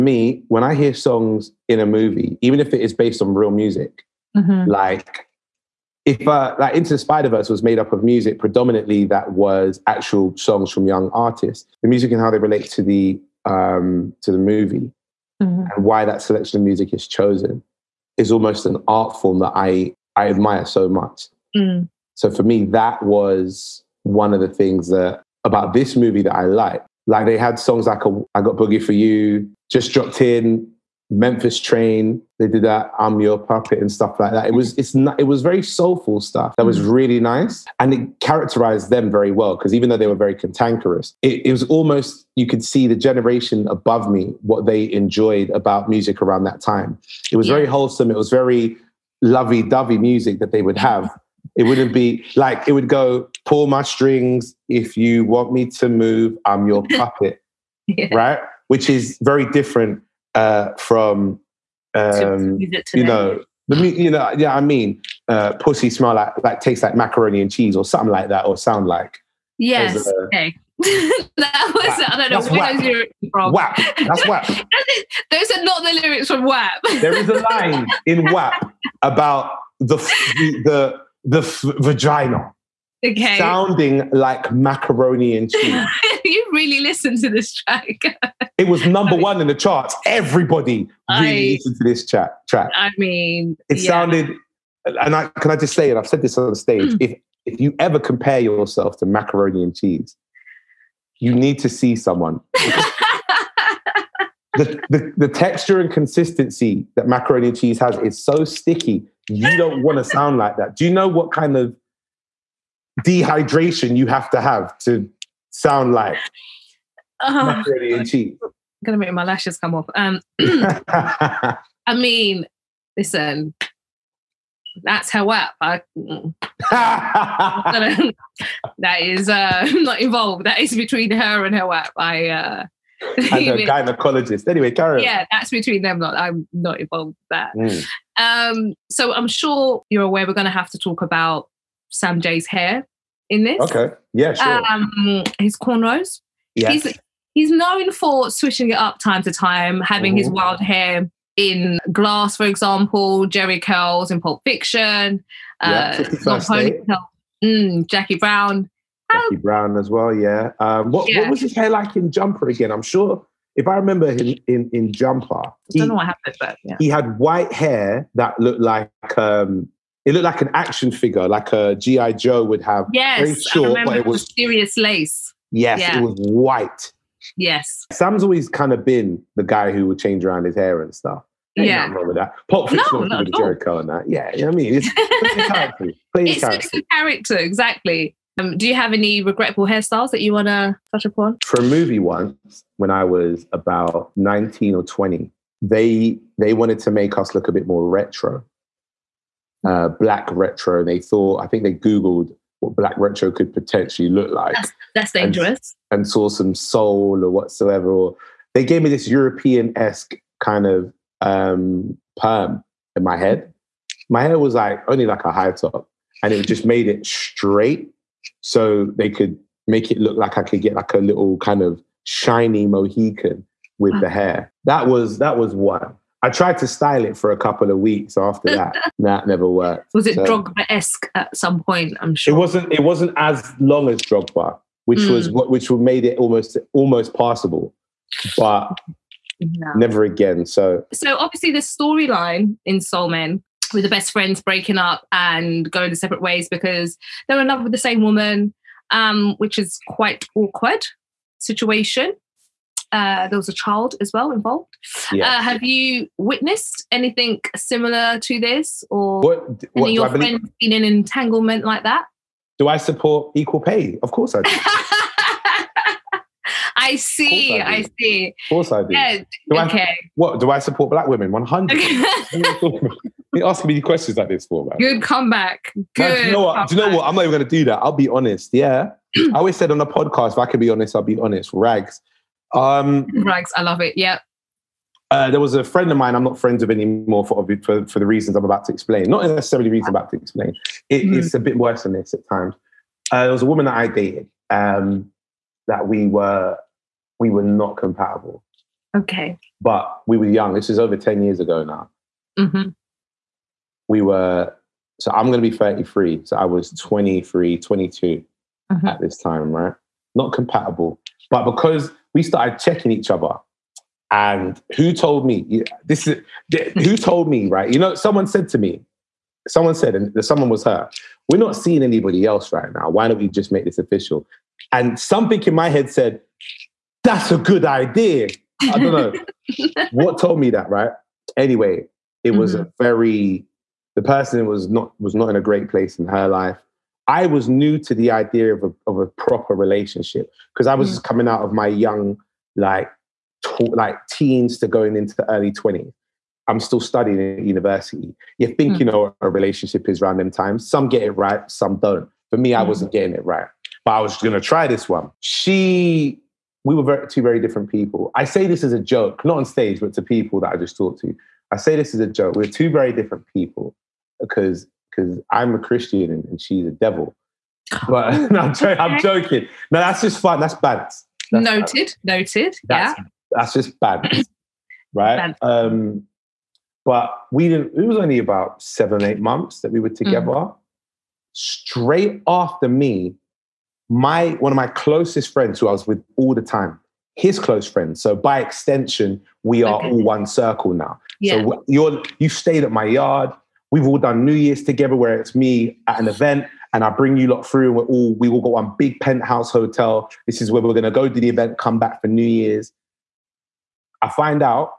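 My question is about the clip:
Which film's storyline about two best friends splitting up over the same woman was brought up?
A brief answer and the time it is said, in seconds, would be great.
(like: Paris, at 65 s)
Soul Men, at 242 s.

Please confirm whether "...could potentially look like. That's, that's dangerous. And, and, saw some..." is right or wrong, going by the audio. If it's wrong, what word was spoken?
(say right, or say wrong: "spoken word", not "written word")
right.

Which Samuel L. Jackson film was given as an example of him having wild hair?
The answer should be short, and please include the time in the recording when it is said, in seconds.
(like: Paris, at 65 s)
Glass, at 151 s.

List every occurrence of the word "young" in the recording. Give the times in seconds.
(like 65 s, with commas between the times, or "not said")
10 s, 300 s, 341 s.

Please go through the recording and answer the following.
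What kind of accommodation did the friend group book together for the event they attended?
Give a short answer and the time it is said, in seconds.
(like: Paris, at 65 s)
Penthouse hotel, at 398 s.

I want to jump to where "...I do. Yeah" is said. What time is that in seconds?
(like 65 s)
268 s.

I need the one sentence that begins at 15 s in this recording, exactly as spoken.
and why that selection of music is chosen is almost an art form that I I admire so much.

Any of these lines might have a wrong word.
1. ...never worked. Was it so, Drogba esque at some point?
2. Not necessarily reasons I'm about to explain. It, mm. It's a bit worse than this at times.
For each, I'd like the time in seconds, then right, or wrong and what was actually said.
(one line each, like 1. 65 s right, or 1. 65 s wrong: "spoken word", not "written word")
1. 229 s right
2. 289 s right.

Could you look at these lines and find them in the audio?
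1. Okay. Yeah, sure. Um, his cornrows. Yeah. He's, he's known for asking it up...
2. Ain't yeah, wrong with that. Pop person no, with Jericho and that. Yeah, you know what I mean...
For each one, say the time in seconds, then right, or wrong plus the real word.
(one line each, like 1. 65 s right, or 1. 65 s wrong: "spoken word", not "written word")
1. 143 s wrong: "swishing", not "asking"
2. 181 s wrong: "fiction", not "person".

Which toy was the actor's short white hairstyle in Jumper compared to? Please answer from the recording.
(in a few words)
GI Joe.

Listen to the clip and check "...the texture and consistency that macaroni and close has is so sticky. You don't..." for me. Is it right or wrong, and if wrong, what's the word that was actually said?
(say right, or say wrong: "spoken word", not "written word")
wrong: "cheese", not "close".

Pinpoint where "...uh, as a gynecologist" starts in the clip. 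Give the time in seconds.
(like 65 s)
132 s.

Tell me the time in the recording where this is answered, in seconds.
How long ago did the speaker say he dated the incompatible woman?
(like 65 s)
300 s.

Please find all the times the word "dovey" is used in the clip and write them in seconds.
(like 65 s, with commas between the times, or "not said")
49 s.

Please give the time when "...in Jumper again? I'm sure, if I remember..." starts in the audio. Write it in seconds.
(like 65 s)
161 s.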